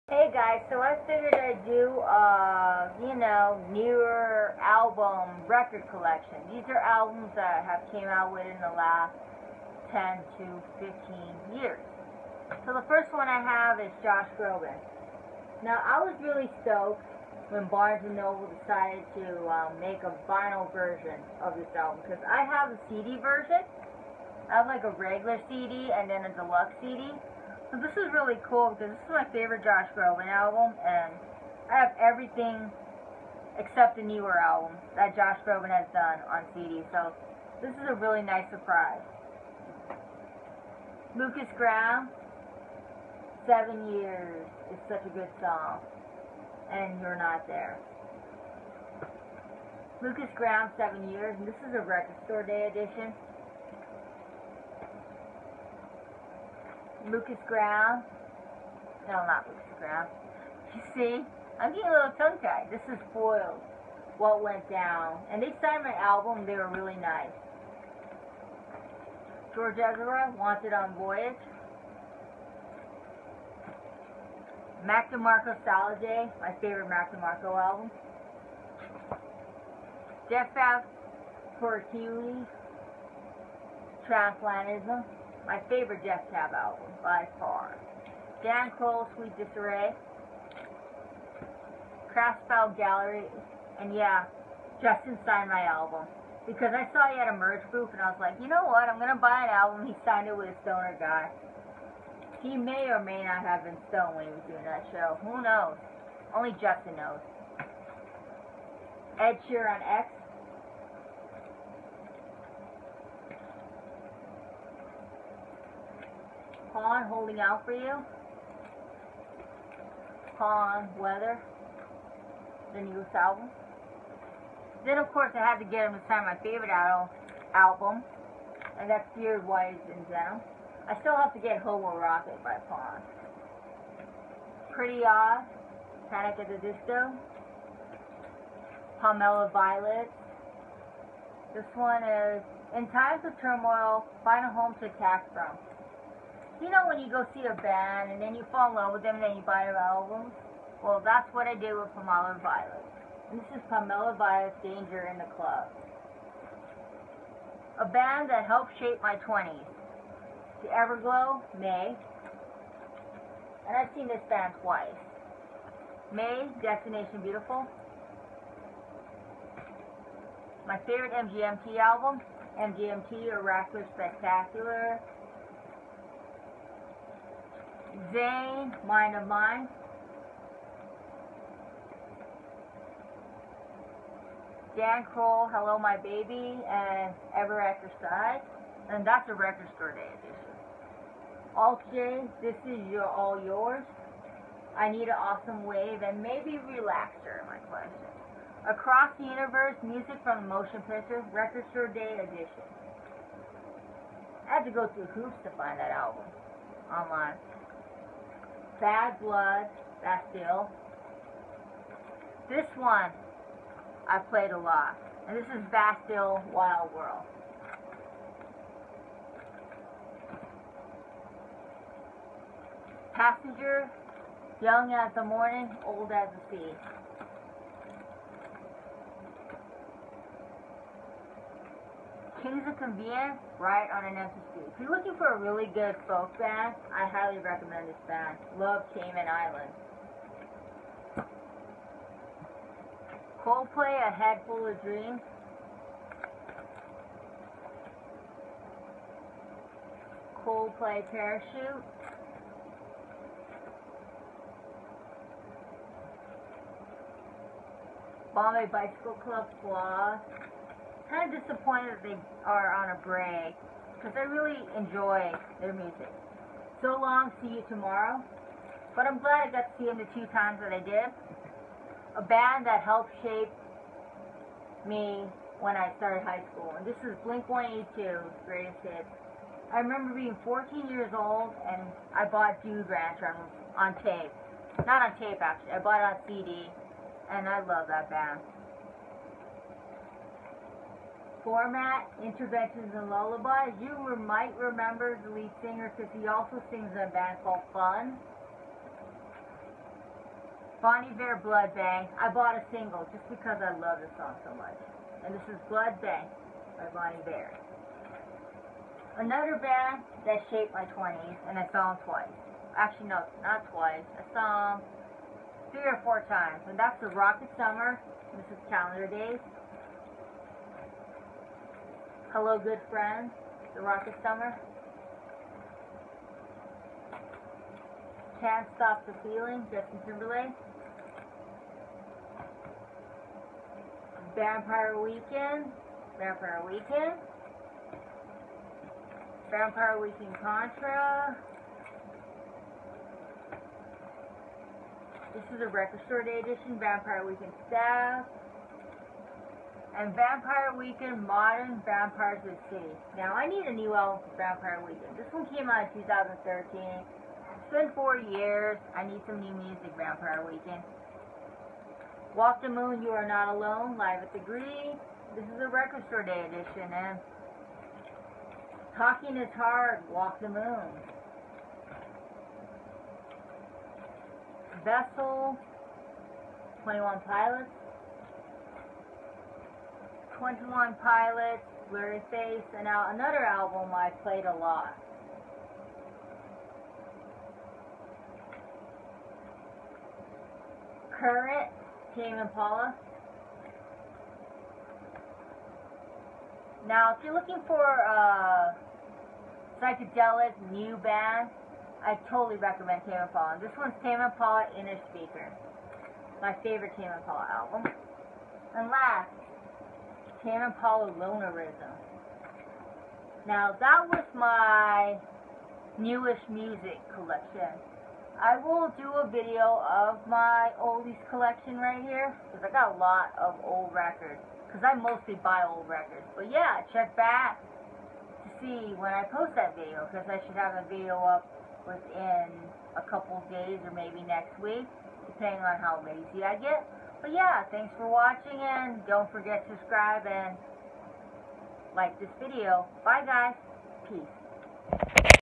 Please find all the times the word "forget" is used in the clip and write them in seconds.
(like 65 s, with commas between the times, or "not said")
439 s.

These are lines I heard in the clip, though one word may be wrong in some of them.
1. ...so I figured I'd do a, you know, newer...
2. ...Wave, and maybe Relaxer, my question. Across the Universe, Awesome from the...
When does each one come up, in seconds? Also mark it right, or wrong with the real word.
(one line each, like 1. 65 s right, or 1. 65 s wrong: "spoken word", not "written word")
1. 0 s right
2. 195 s wrong: "Music", not "Awesome".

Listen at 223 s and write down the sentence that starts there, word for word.
Passenger, young as the morning, old as the sea.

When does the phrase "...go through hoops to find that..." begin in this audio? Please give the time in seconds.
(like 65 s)
204 s.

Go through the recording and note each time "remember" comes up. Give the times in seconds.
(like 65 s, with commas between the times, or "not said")
279 s, 294 s.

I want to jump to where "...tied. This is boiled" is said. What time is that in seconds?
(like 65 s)
62 s.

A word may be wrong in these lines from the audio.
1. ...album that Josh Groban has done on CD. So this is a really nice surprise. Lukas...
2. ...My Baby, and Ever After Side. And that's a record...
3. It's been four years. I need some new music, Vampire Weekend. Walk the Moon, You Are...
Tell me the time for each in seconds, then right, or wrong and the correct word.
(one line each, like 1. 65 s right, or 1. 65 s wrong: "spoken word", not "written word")
1. 34 s right
2. 185 s right
3. 356 s right.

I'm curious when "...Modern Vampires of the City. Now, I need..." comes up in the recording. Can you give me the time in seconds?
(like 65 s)
351 s.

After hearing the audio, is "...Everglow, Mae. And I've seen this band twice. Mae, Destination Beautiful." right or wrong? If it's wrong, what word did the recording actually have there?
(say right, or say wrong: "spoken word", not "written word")
right.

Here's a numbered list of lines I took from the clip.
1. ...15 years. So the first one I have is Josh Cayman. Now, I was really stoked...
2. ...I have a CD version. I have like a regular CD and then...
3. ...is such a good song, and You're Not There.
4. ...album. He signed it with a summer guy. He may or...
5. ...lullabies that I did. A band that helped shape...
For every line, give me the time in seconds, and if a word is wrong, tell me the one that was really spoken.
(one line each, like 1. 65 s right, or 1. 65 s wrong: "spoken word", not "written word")
1. 10 s wrong: "Groban", not "Cayman"
2. 22 s right
3. 44 s right
4. 99 s wrong: "stoner", not "summer"
5. 270 s wrong: "times", not "lullabies".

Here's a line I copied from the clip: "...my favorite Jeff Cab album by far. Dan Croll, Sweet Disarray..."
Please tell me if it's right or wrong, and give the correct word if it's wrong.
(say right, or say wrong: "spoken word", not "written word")
right.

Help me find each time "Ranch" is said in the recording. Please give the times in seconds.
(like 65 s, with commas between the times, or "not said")
282 s.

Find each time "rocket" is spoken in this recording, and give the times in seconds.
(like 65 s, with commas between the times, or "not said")
131 s, 317 s, 323 s.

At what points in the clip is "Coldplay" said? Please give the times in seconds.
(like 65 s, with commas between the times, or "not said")
243 s, 250 s.